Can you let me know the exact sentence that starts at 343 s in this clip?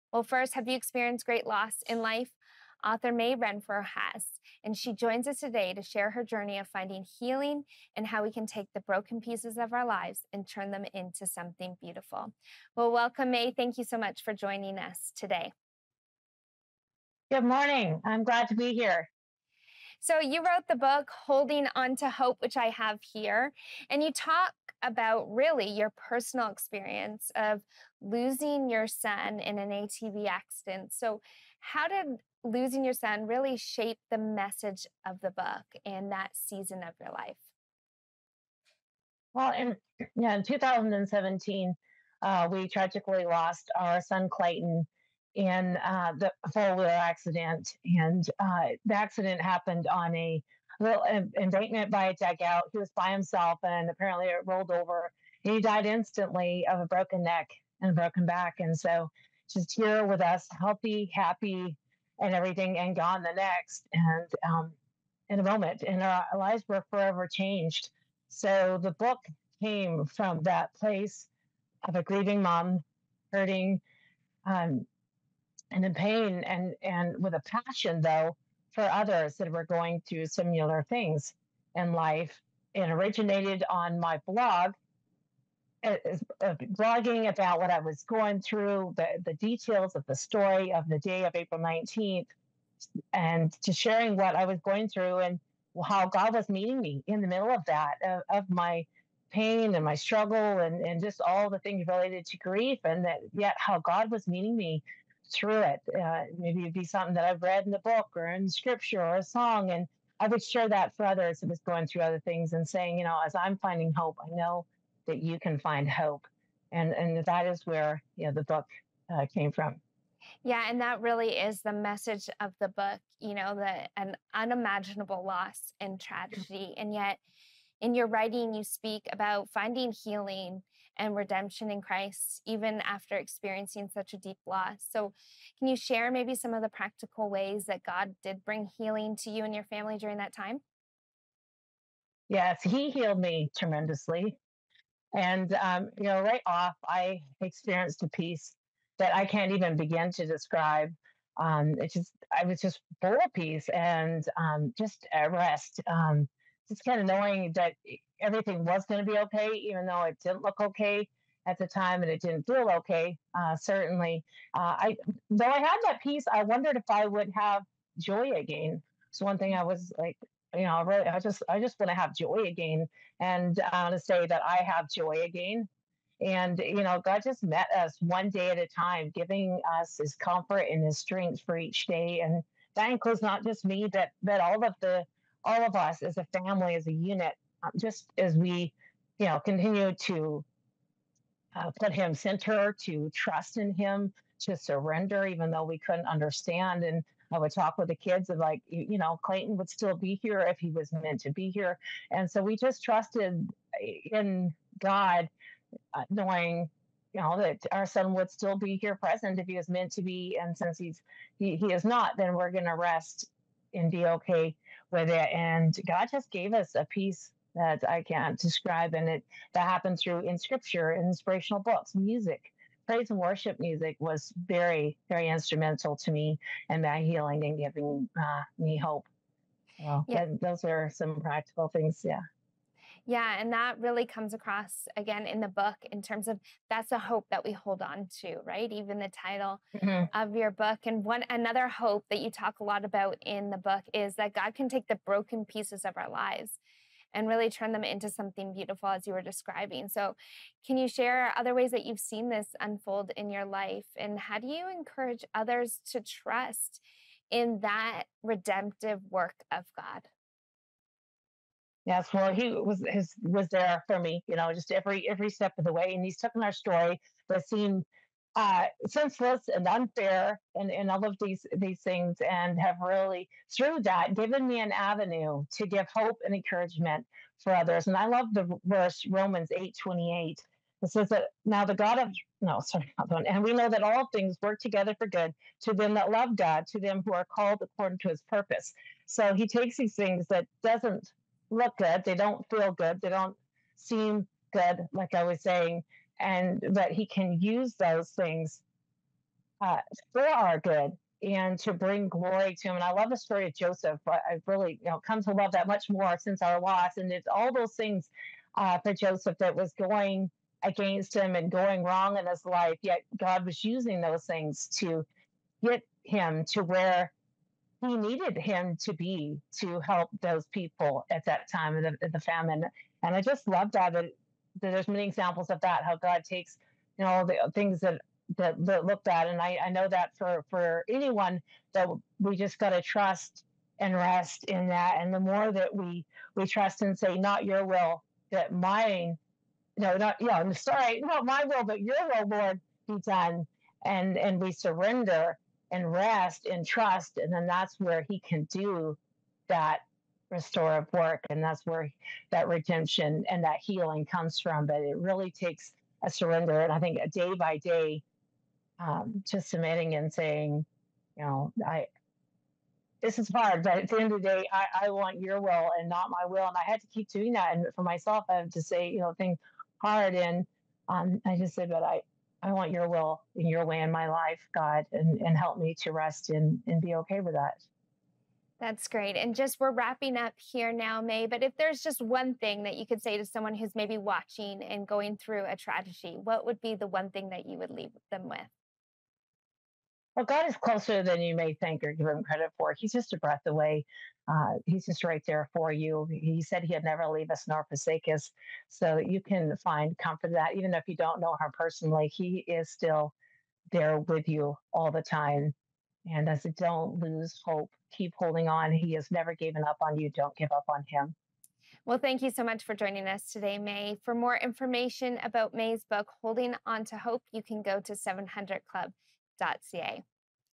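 And, and we surrender and rest and trust.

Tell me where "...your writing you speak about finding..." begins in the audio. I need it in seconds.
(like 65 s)
127 s.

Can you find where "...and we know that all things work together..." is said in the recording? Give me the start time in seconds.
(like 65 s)
283 s.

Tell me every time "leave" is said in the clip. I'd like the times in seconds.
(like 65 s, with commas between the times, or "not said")
387 s, 397 s.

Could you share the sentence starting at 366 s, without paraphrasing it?
And I had to keep doing that.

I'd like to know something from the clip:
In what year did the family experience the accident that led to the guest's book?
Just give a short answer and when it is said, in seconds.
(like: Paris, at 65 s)
2017, at 40 s.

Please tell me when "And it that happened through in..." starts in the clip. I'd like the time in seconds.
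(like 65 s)
218 s.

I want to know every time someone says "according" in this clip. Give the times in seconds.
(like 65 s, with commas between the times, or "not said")
287 s.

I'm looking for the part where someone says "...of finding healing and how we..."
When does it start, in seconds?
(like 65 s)
6 s.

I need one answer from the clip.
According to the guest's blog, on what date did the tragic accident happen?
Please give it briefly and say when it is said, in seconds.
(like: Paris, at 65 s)
April 19th, at 91 s.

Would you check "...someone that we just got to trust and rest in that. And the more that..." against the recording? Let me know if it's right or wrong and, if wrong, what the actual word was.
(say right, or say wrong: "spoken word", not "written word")
wrong: "anyone", not "someone".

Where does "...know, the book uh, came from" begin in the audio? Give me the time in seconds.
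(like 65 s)
118 s.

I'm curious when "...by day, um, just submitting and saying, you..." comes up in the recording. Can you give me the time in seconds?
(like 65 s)
357 s.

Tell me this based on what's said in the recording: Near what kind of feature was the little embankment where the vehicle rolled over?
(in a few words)
a dugout.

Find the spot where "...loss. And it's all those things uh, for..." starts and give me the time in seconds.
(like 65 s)
306 s.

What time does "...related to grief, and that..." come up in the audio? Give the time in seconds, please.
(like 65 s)
101 s.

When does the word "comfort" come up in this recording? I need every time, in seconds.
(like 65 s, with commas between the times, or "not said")
180 s, 399 s.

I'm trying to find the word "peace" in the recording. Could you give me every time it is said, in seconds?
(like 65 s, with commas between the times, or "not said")
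148 s, 153 s, 166 s, 216 s.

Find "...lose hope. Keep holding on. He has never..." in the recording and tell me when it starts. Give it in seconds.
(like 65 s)
406 s.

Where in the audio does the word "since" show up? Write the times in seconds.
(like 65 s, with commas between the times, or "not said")
210 s, 306 s.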